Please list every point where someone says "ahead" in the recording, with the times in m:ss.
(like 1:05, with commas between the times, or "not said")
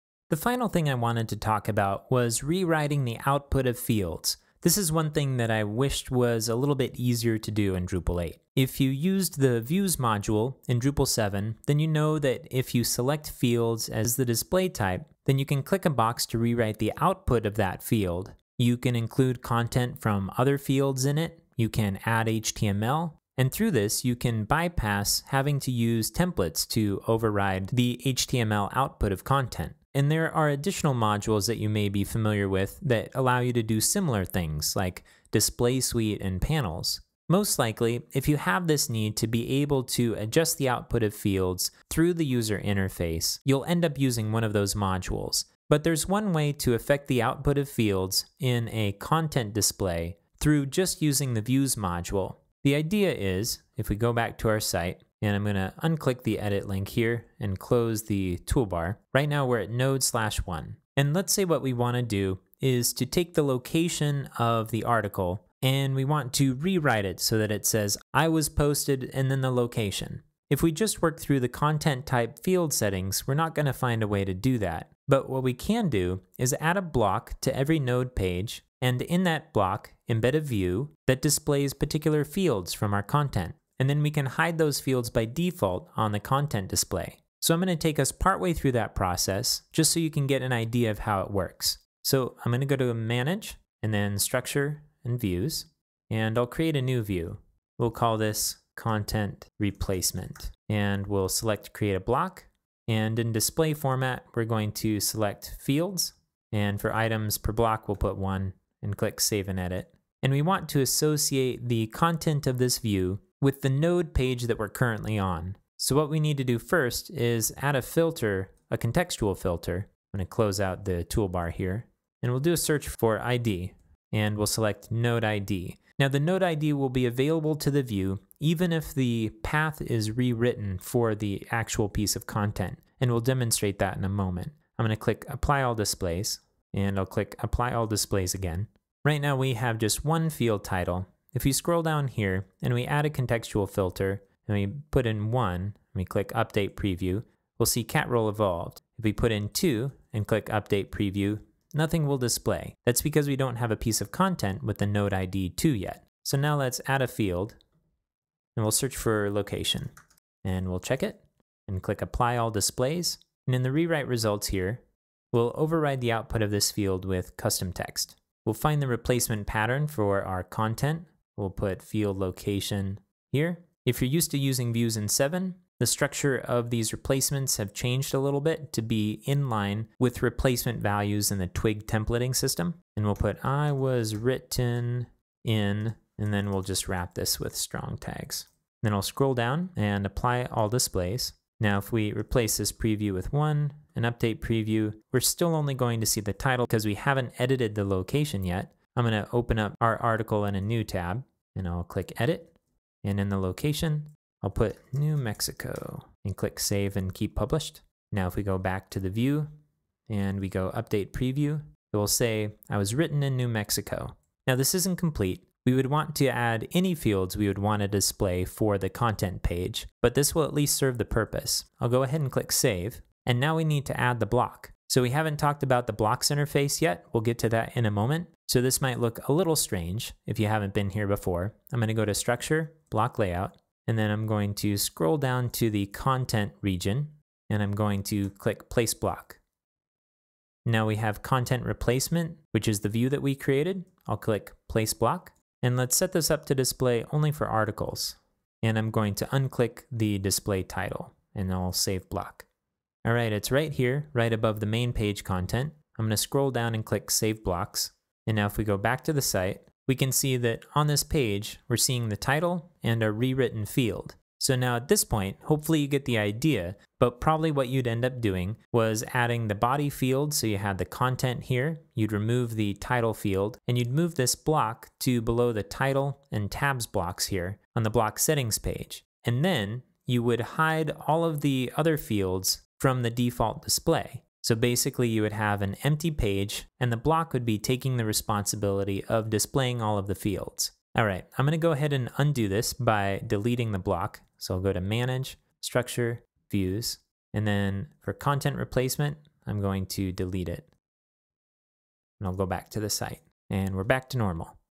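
3:42, 4:51.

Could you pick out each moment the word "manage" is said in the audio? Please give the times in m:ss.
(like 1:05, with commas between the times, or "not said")
1:32, 4:54.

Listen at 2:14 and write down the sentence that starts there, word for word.
I'm gonna click Apply All Displays, and I'll click Apply All Displays again.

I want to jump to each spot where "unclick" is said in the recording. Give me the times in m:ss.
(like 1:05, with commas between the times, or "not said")
0:55, 4:09.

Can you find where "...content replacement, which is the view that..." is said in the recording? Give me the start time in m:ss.
4:01.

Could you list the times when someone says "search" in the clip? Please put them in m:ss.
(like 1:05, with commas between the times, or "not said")
2:02, 2:38.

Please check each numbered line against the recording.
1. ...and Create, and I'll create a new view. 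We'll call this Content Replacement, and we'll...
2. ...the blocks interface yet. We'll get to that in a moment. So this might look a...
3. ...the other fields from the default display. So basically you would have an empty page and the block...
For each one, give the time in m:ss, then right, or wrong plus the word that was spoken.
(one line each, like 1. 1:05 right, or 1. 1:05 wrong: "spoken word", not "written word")
1. 1:35 wrong: "Views", not "Create"
2. 3:45 right
3. 4:41 right.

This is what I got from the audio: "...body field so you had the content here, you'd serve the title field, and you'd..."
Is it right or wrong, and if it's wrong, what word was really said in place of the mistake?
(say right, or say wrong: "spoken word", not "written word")
wrong: "remove", not "serve".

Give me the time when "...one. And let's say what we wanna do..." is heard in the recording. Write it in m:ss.
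1:00.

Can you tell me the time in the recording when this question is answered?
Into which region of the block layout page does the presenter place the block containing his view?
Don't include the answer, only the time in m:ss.
3:55.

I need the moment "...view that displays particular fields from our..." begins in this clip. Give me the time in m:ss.
1:20.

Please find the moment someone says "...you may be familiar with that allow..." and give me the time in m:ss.
0:31.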